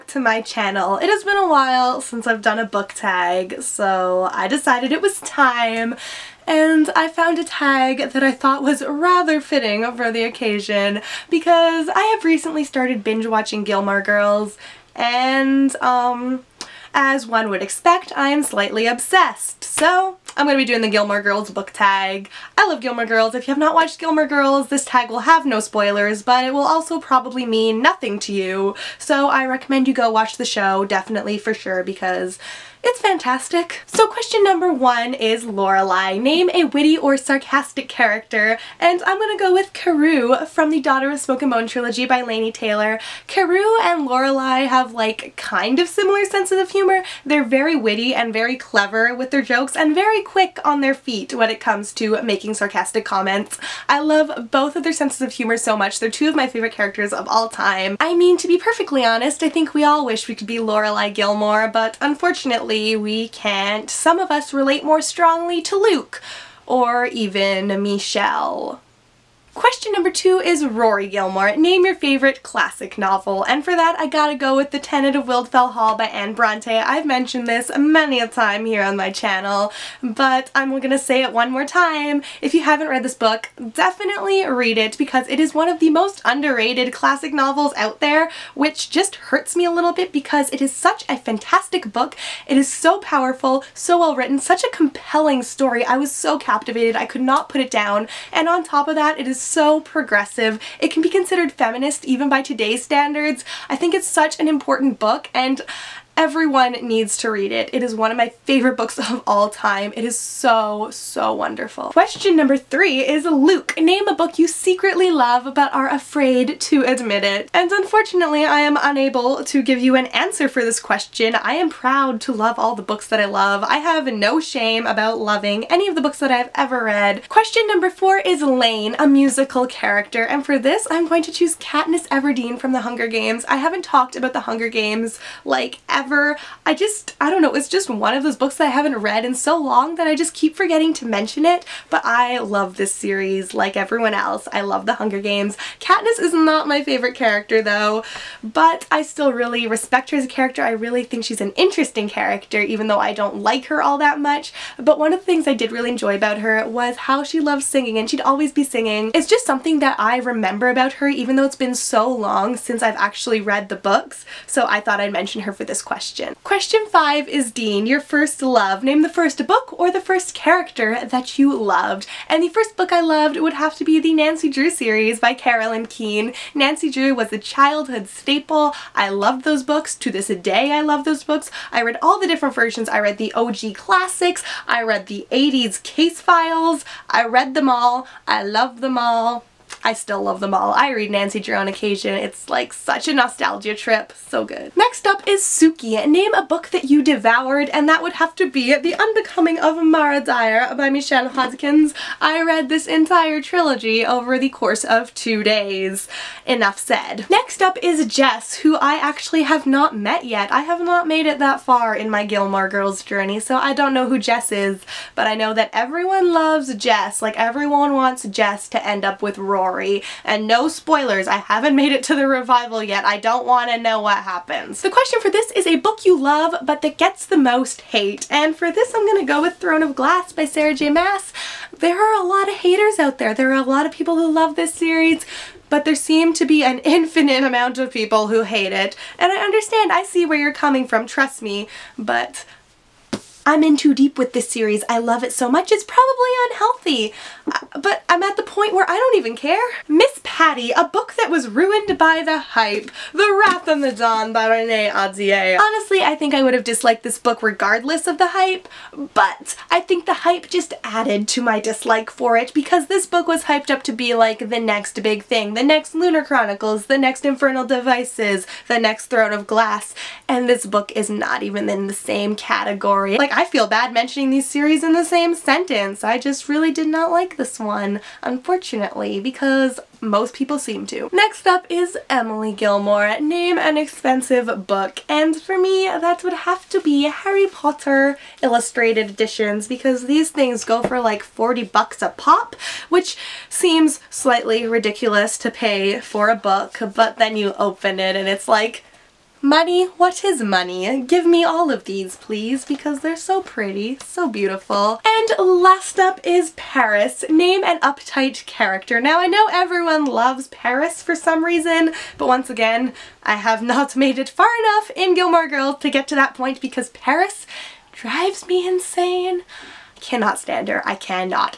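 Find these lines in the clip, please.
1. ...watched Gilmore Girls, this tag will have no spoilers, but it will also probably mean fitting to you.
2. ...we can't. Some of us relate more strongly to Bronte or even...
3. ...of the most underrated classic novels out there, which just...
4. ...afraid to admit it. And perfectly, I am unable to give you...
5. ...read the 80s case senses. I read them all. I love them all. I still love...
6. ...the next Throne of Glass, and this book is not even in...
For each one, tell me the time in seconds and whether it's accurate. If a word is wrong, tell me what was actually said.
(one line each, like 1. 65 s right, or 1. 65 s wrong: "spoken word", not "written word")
1. 23 s wrong: "nothing", not "fitting"
2. 62 s wrong: "Luke", not "Bronte"
3. 85 s right
4. 115 s wrong: "unfortunately", not "perfectly"
5. 184 s wrong: "files", not "senses"
6. 268 s right.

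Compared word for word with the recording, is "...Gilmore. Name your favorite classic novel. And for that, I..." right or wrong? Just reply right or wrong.
right.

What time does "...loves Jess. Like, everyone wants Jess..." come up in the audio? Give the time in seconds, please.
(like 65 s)
216 s.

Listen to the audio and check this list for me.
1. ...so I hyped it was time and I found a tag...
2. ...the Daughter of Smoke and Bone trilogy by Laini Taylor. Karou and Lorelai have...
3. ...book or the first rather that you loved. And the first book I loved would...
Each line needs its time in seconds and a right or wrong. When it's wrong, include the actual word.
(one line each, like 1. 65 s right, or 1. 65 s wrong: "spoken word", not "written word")
1. 3 s wrong: "decided", not "hyped"
2. 40 s right
3. 169 s wrong: "character", not "rather".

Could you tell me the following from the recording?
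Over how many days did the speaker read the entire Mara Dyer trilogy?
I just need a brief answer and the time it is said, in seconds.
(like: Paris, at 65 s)
2, at 205 s.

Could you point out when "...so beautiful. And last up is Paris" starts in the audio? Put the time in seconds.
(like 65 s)
304 s.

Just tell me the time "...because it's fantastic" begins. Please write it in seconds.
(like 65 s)
31 s.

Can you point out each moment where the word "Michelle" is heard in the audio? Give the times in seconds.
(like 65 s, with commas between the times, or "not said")
67 s, 200 s.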